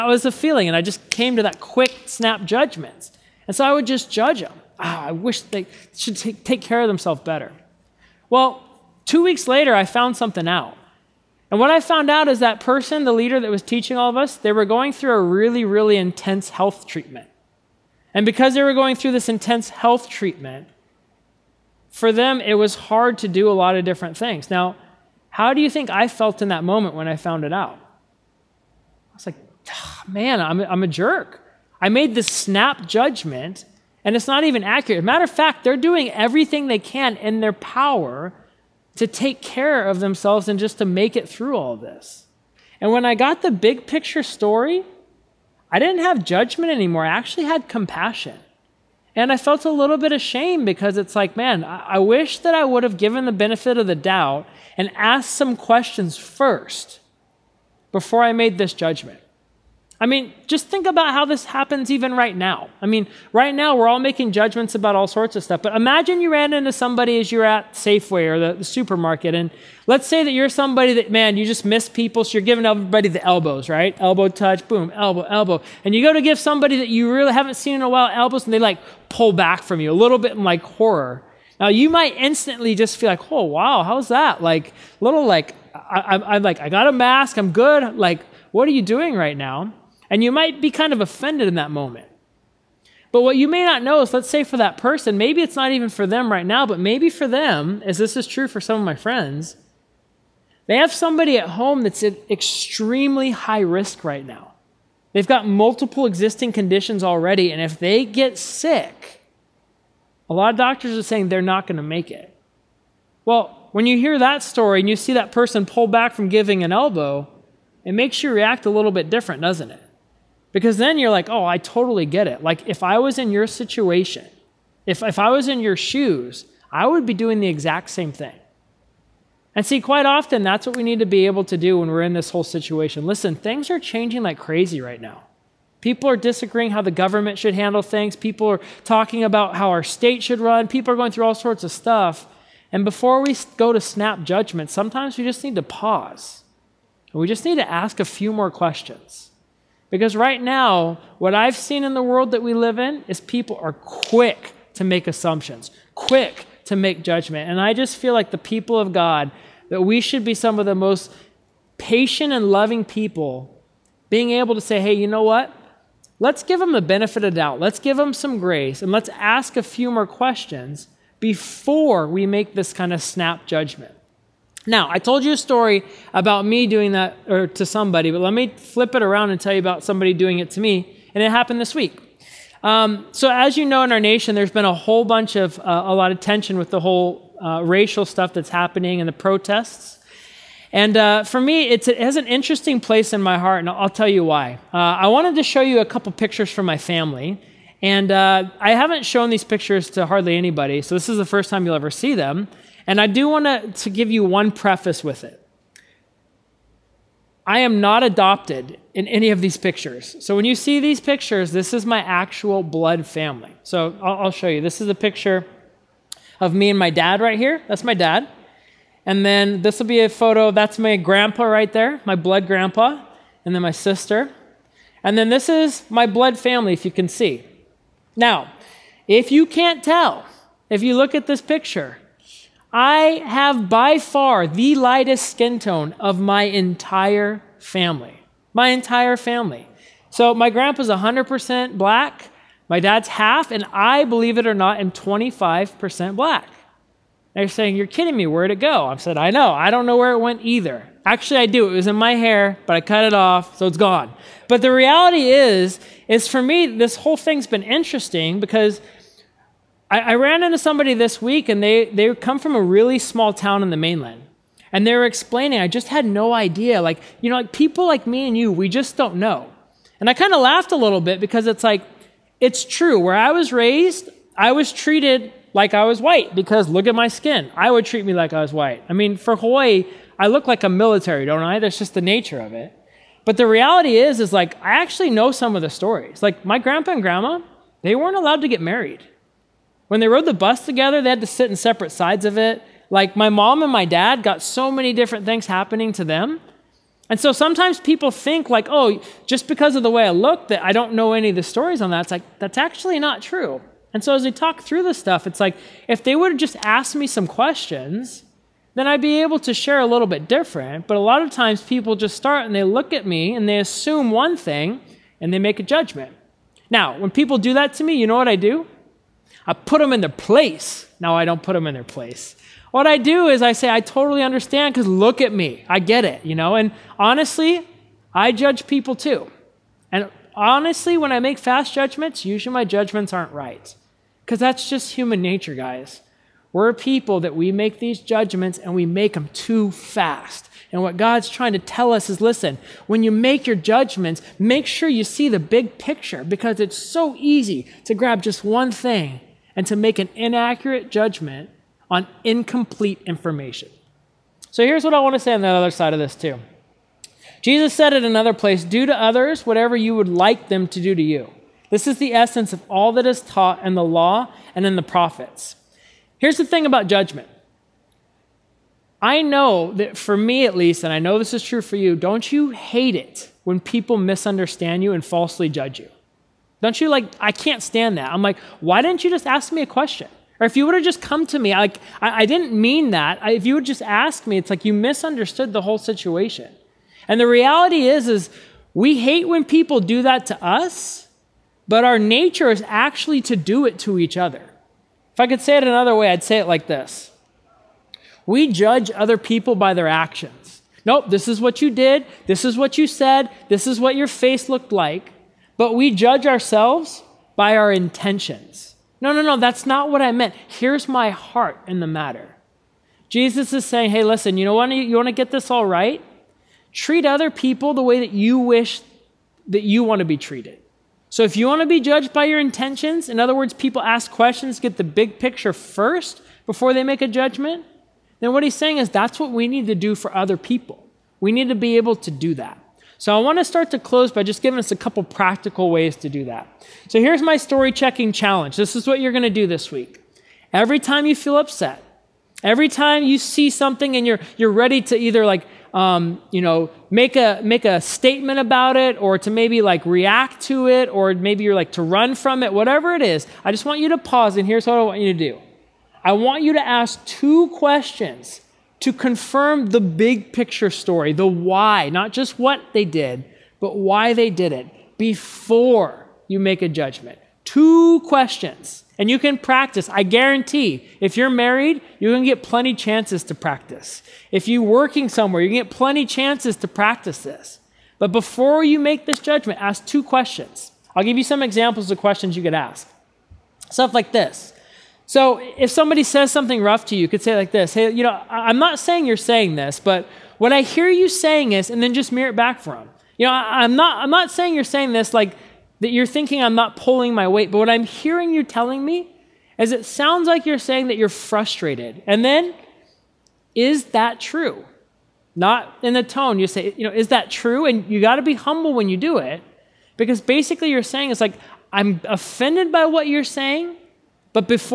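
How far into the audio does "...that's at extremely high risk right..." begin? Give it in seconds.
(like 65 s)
101 s.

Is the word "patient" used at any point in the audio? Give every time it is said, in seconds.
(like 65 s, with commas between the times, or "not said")
161 s.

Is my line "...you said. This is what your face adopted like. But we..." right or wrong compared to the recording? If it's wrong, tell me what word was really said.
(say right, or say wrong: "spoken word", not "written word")
wrong: "looked", not "adopted".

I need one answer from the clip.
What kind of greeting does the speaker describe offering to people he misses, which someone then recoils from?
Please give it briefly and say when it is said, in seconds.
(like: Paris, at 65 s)
Elbow touch, at 73 s.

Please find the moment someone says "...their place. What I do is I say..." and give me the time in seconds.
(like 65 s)
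321 s.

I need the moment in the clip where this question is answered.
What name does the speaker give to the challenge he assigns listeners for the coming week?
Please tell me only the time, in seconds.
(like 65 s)
437 s.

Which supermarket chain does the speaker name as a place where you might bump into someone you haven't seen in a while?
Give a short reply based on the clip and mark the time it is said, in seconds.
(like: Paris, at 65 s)
Safeway, at 67 s.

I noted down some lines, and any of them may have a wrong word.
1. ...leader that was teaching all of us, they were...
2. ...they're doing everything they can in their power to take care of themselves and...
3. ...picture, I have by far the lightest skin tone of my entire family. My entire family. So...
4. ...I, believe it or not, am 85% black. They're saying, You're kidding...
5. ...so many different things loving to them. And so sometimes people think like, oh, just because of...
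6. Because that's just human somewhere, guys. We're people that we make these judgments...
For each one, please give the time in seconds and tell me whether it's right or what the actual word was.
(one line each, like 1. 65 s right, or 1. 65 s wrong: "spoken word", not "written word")
1. 13 s right
2. 35 s right
3. 231 s right
4. 243 s wrong: "25", not "85"
5. 294 s wrong: "happening", not "loving"
6. 334 s wrong: "nature", not "somewhere".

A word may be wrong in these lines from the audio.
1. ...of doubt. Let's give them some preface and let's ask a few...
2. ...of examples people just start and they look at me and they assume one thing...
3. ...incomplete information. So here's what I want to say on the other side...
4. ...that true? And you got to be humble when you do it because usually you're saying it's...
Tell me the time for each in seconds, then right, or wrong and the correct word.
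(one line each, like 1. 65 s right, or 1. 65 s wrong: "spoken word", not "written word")
1. 167 s wrong: "grace", not "preface"
2. 311 s wrong: "times", not "examples"
3. 352 s right
4. 507 s wrong: "basically", not "usually".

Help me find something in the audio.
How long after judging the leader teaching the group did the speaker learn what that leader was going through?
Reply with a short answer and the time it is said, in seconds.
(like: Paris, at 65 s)
2 weeks, at 9 s.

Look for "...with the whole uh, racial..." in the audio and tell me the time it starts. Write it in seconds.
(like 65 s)
186 s.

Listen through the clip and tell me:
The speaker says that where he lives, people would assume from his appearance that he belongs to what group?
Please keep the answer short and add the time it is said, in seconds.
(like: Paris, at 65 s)
military, at 280 s.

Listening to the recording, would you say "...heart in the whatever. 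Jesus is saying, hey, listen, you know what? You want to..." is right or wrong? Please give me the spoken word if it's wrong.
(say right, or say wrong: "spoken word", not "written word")
wrong: "matter", not "whatever".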